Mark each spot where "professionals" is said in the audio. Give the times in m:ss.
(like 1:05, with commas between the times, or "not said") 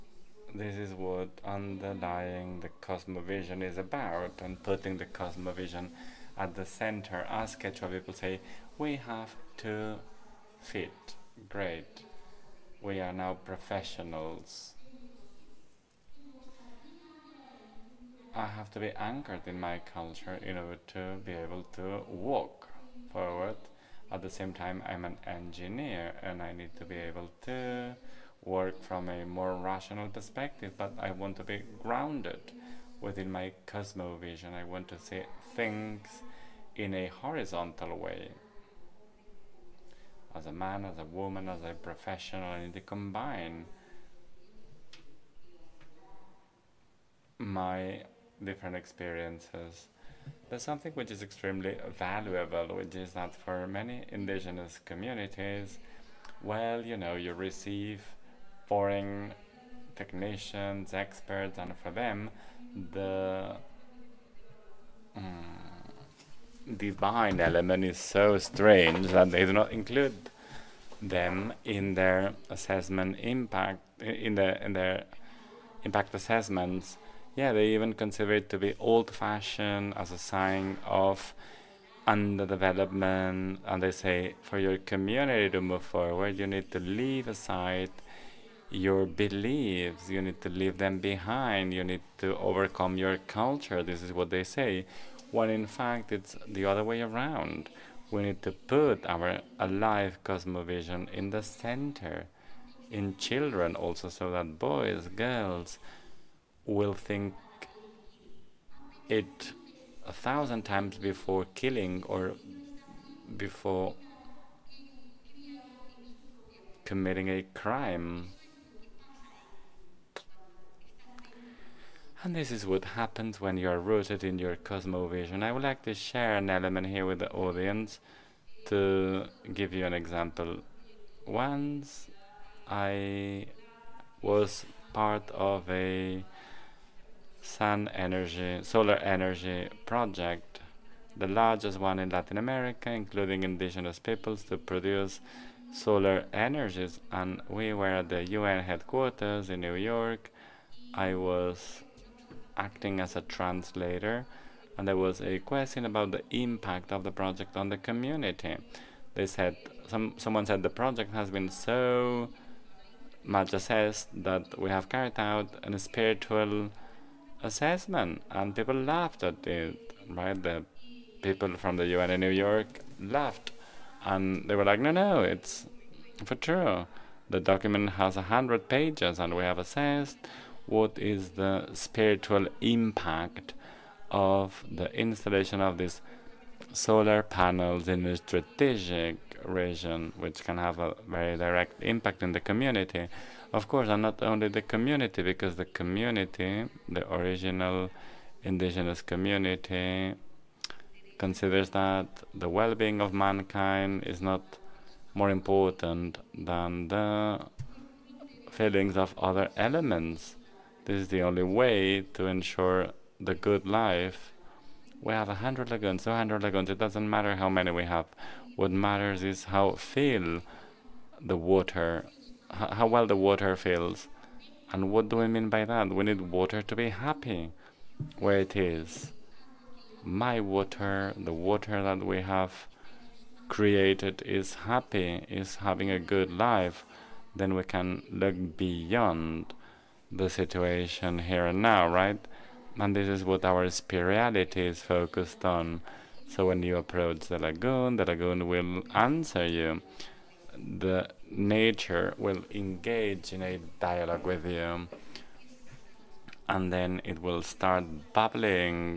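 0:13, 0:41.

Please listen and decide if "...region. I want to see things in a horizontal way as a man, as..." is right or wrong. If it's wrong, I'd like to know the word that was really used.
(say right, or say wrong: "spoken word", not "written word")
wrong: "cosmovision", not "region".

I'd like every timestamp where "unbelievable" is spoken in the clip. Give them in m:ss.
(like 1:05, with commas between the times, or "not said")
not said.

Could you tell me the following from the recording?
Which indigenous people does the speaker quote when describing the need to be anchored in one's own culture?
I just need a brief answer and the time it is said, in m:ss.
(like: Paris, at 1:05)
Quechua, at 0:07.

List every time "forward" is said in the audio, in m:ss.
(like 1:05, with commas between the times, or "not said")
0:23, 1:25.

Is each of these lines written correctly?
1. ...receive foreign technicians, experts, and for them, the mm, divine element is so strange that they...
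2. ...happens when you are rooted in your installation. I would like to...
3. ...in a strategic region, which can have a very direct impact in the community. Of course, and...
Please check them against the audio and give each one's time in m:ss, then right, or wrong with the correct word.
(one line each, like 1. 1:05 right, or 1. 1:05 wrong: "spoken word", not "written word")
1. 0:57 right
2. 2:02 wrong: "cosmovision", not "installation"
3. 3:07 right.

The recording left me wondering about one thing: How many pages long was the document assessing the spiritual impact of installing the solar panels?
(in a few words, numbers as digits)
100.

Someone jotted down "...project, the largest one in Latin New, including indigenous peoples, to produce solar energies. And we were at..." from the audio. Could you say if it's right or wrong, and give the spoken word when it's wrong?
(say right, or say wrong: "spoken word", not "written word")
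wrong: "America", not "New".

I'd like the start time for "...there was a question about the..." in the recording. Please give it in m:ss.
2:34.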